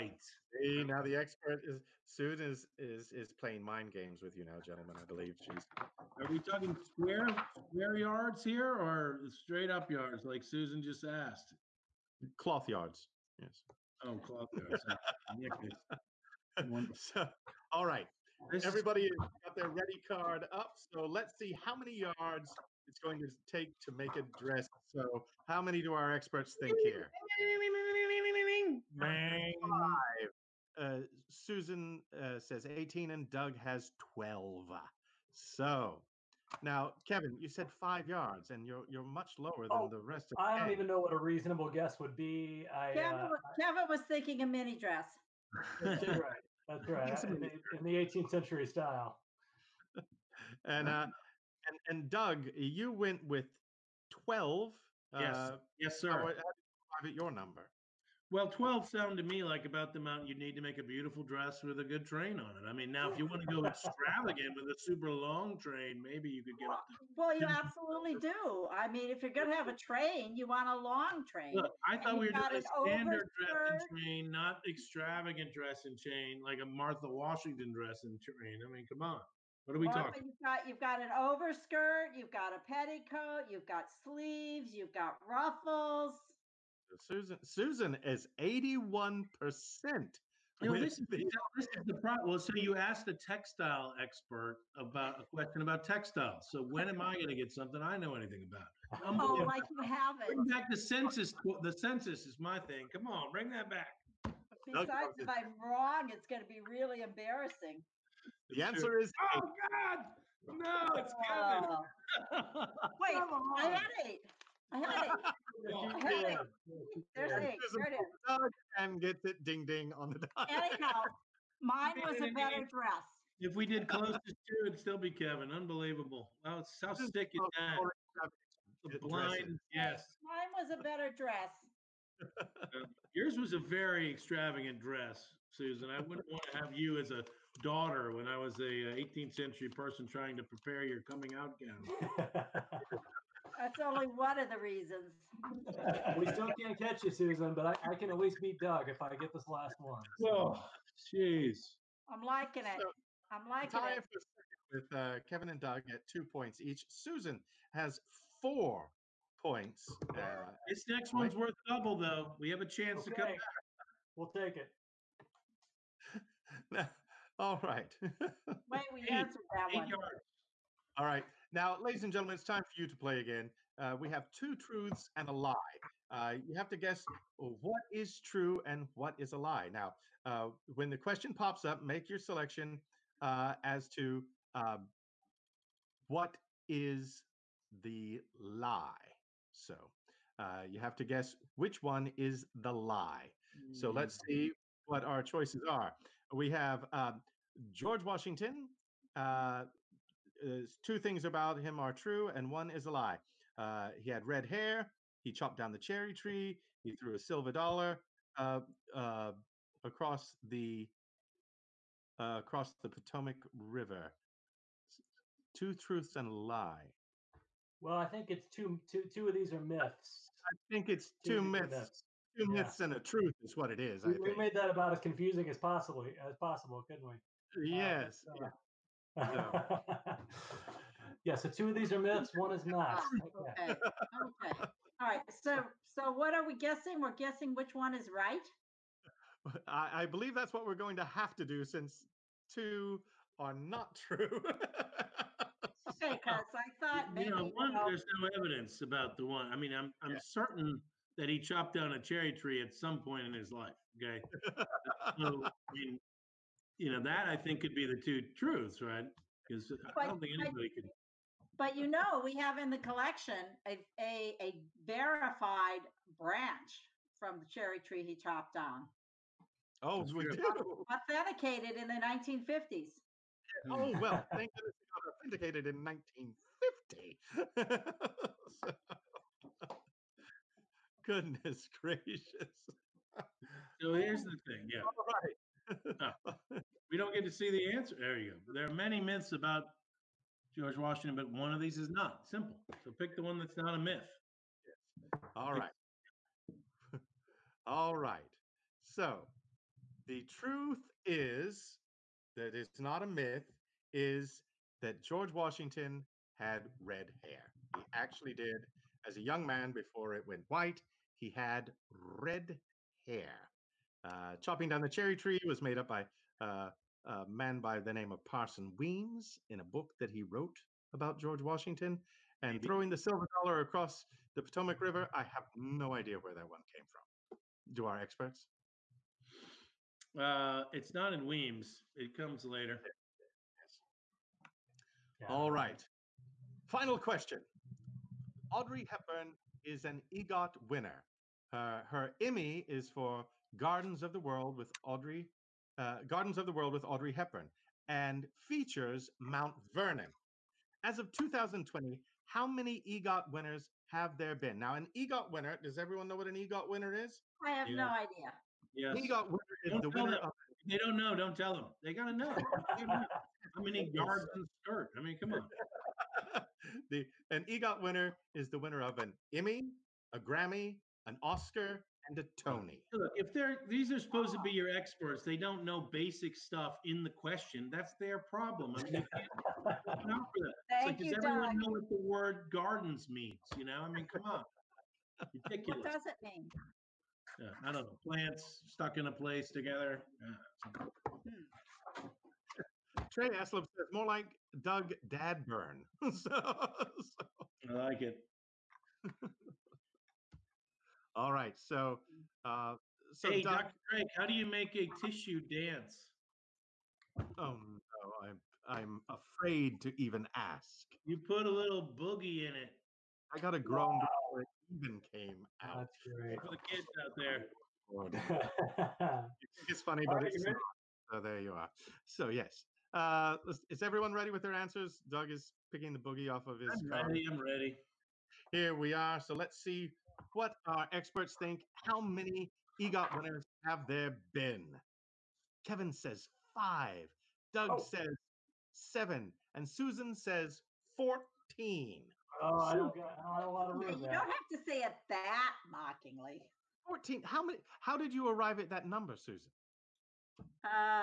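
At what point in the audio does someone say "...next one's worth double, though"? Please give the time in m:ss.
2:40.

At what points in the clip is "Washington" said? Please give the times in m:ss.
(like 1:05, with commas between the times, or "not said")
1:17, 3:18, 4:50, 5:05, 5:21.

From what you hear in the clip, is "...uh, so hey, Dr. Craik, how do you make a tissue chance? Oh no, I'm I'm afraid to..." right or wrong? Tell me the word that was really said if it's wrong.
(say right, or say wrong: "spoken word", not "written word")
wrong: "dance", not "chance".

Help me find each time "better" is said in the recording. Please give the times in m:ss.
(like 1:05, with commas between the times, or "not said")
2:02, 2:10.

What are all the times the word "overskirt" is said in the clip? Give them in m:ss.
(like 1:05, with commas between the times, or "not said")
1:21.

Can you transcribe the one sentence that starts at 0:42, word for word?
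I, uh, Kevin, uh, was, Kevin was thinking a mini dress.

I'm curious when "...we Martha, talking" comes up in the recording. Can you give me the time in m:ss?
1:19.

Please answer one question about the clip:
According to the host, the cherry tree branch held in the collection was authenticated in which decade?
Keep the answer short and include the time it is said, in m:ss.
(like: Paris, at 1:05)
1950s, at 4:31.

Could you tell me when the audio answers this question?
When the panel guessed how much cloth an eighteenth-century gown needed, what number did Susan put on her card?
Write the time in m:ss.
0:32.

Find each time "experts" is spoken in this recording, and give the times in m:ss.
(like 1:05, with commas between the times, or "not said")
0:01, 0:26, 1:33, 5:28, 6:14, 7:10.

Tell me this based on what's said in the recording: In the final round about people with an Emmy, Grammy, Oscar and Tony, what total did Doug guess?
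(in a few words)
7.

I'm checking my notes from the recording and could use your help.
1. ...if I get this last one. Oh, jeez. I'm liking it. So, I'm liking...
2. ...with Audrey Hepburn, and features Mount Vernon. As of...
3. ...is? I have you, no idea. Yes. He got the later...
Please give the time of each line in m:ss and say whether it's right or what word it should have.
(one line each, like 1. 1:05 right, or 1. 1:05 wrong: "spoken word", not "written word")
1. 2:28 right
2. 5:46 right
3. 5:56 wrong: "winner", not "later".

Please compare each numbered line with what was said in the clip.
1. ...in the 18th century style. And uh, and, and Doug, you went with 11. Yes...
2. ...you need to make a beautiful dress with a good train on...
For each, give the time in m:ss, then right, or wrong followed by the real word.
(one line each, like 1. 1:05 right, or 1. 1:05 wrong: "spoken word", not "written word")
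1. 0:47 wrong: "12", not "11"
2. 1:00 right.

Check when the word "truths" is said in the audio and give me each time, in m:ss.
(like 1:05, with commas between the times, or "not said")
2:54, 3:35, 3:43, 4:18, 5:00.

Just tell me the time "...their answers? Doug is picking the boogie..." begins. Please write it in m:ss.
7:04.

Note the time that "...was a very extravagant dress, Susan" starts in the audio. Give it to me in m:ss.
2:13.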